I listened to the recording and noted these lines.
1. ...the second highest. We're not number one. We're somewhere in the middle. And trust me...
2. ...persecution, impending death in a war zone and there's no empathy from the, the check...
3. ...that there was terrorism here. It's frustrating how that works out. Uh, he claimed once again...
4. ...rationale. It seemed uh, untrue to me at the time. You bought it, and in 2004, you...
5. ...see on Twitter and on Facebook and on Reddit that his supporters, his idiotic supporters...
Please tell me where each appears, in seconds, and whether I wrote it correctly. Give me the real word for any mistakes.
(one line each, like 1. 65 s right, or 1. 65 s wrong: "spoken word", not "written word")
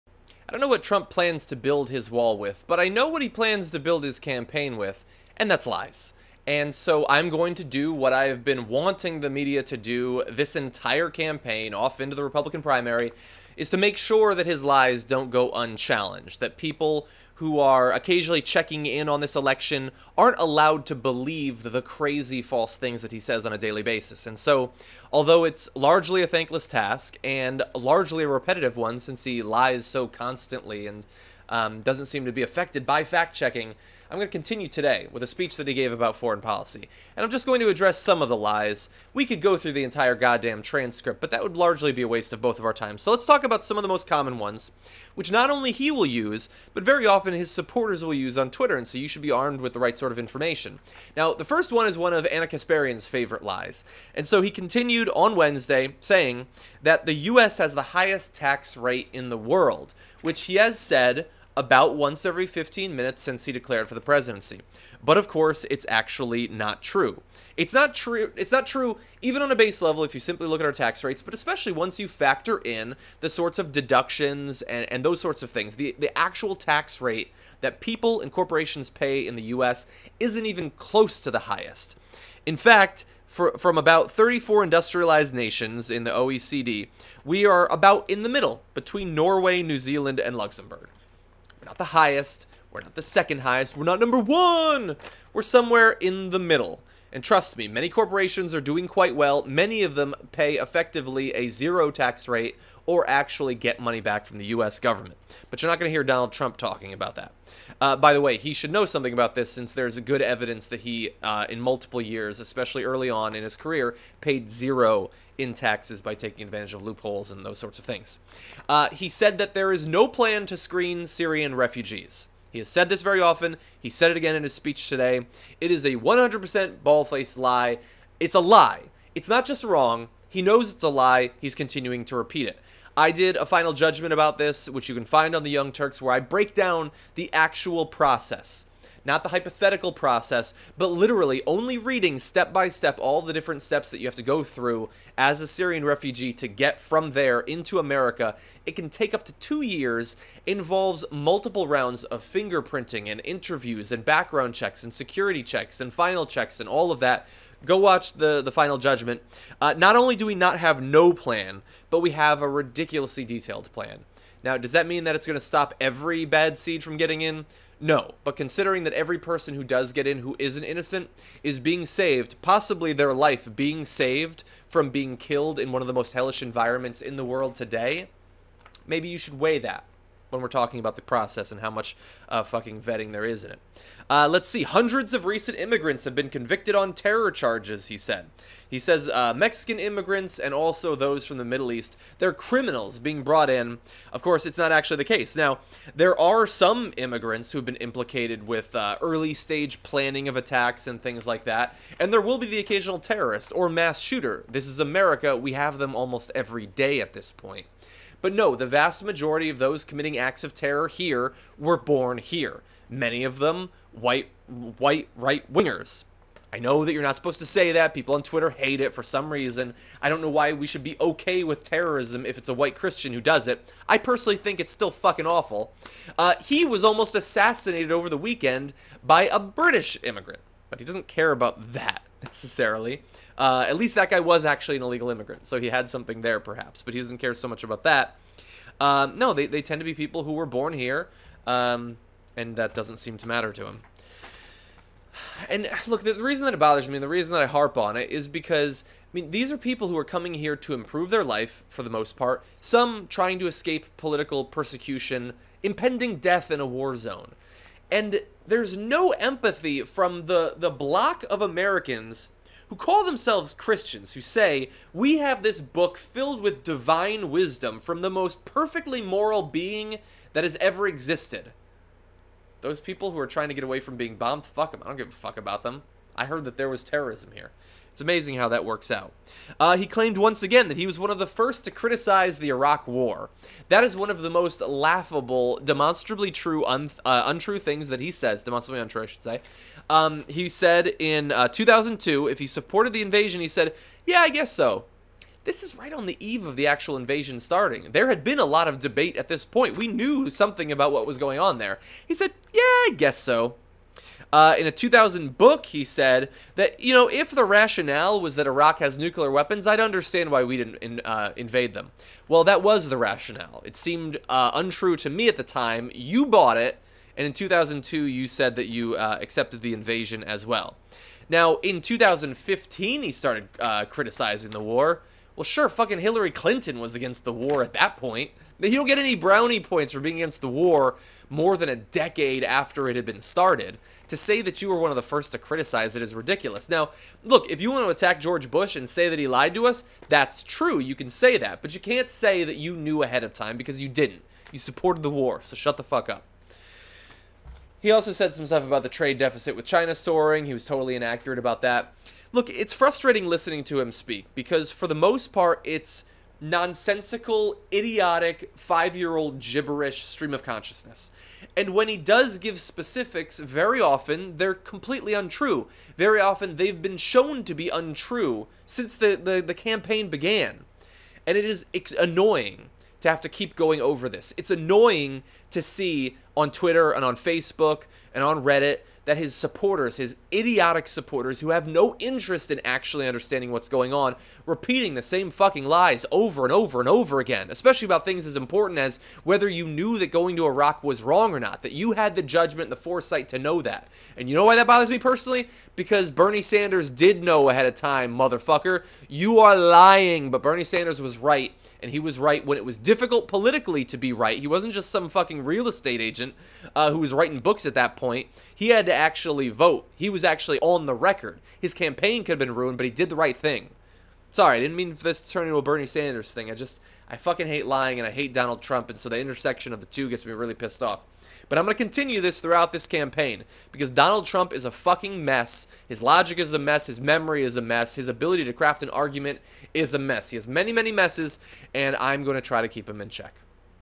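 1. 92 s right
2. 254 s wrong: "block", not "check"
3. 276 s wrong: "amazing", not "frustrating"
4. 312 s wrong: "2002", not "2004"
5. 375 s right.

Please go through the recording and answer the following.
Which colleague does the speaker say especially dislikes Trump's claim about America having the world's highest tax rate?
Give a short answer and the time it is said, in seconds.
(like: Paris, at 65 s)
Ana Kasparian, at 52 s.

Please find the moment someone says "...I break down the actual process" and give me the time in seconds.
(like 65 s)
136 s.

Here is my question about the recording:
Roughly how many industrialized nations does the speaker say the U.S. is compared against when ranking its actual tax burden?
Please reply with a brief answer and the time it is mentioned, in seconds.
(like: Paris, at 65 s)
34, at 84 s.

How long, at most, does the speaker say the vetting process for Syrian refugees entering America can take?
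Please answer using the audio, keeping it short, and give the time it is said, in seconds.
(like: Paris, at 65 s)
2 years, at 149 s.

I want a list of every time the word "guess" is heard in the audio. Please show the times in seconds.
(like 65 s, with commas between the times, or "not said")
294 s, 302 s.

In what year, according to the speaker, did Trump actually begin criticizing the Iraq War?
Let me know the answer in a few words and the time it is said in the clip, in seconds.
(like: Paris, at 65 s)
2015, at 321 s.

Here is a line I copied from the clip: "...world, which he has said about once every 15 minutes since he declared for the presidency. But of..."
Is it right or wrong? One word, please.
right.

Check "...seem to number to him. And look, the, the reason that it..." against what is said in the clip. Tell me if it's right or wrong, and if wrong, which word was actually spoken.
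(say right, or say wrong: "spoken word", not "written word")
wrong: "matter", not "number".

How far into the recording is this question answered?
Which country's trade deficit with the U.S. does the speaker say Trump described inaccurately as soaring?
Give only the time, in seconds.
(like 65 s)
349 s.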